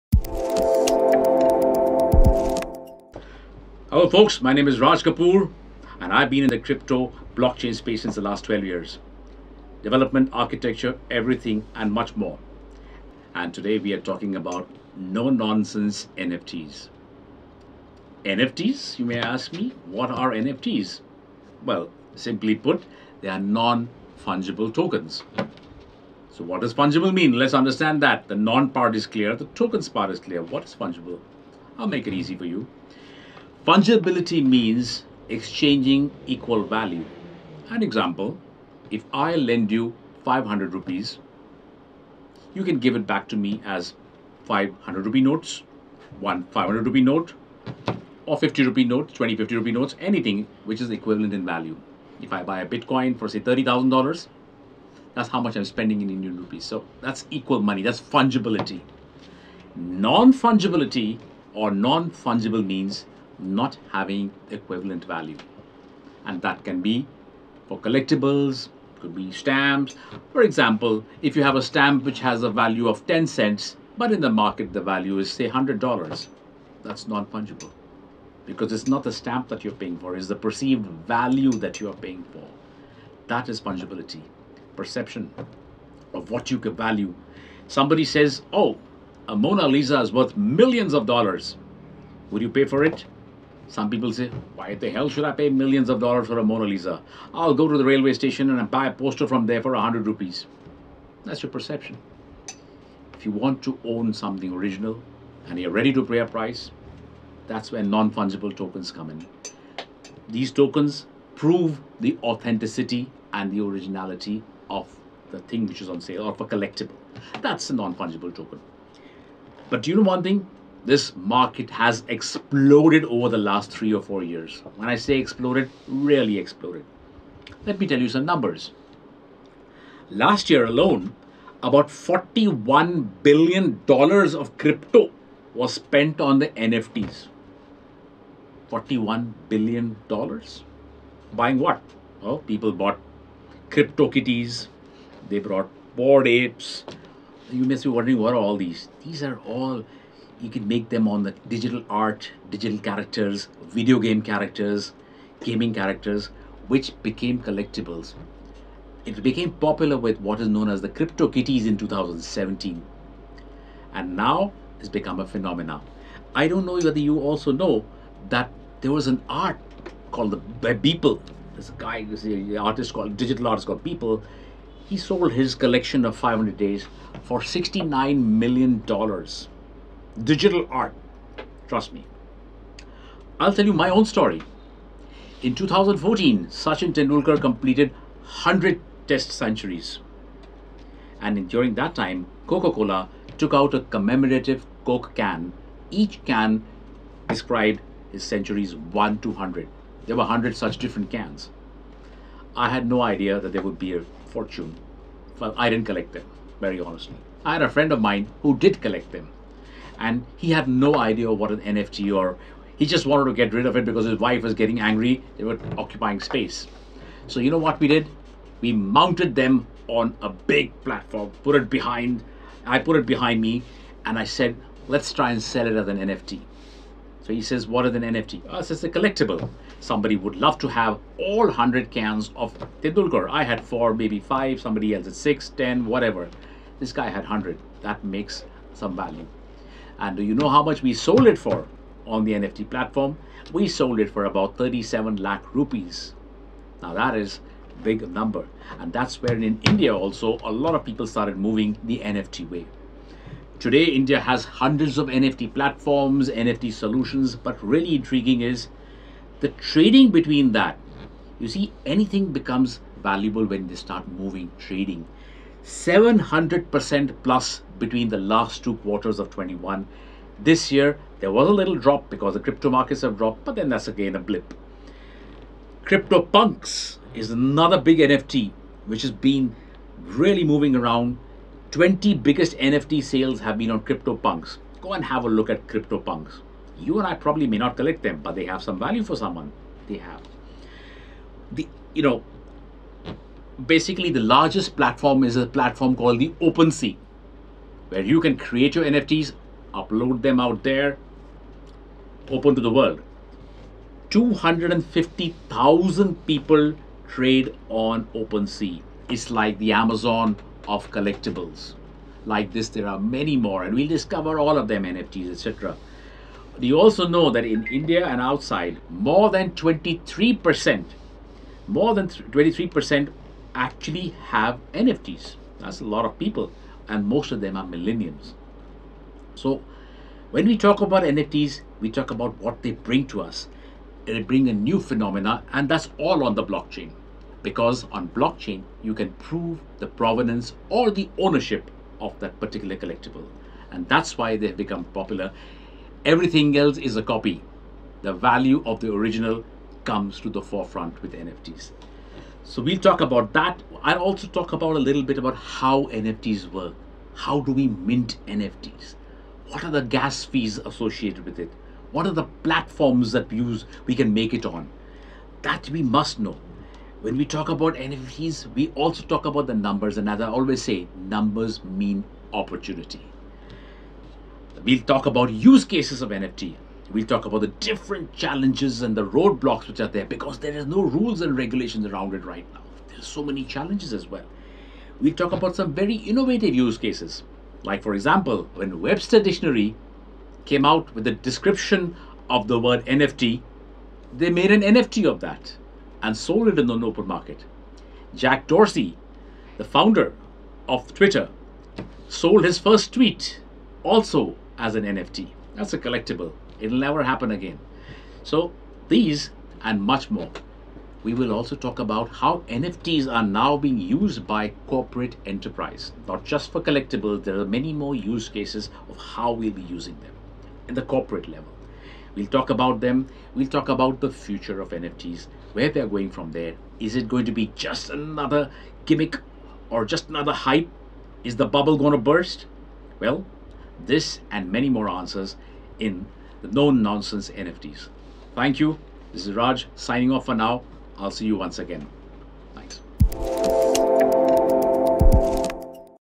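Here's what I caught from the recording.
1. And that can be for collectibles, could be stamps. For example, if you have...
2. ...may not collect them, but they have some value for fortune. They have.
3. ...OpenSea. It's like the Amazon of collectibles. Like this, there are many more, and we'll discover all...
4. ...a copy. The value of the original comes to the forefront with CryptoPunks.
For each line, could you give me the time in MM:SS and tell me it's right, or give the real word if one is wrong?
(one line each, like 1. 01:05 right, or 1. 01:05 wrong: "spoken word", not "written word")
1. 01:06 right
2. 04:47 wrong: "someone", not "fortune"
3. 05:08 right
4. 05:46 wrong: "NFTs", not "CryptoPunks".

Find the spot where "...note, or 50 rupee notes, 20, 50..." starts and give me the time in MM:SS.
00:47.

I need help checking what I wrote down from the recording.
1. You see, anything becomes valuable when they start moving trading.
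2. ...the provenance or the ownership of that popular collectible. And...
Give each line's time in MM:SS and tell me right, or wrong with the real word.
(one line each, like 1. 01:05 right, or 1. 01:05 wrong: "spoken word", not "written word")
1. 04:21 right
2. 05:39 wrong: "particular", not "popular".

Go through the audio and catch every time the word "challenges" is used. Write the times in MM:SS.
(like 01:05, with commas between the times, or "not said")
06:18, 06:23.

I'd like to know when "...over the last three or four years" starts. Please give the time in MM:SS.
02:03.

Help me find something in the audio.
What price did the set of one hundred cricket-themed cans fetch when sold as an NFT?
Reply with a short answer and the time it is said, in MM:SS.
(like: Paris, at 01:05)
37 lakh rupees, at 04:04.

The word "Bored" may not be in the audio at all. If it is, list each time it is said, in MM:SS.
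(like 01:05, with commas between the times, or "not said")
02:25.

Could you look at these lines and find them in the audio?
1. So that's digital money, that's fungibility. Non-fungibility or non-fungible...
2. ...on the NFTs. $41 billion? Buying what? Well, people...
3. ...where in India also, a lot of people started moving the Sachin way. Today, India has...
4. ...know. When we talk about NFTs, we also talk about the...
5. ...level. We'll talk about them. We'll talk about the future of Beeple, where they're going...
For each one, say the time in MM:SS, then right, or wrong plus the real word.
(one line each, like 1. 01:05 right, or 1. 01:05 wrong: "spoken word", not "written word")
1. 00:56 wrong: "equal", not "digital"
2. 02:16 right
3. 04:09 wrong: "NFT", not "Sachin"
4. 06:06 right
5. 07:01 wrong: "NFTs", not "Beeple".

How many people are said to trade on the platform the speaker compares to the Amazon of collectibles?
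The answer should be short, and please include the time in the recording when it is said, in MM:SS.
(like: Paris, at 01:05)
250,000, at 05:04.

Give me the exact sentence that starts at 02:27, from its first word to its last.
You may be wondering what are all these?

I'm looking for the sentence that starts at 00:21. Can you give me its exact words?
Well, simply put, they are non-fungible tokens.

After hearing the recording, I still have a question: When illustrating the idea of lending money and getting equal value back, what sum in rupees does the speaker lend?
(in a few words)
500 rupees.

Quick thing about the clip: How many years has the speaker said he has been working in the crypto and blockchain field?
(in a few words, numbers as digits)
12 years.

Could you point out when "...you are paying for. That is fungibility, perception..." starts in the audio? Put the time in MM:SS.
01:21.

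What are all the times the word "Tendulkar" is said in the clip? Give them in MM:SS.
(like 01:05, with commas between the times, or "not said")
03:06, 03:52.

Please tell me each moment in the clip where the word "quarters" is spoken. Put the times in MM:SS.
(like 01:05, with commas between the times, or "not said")
04:28.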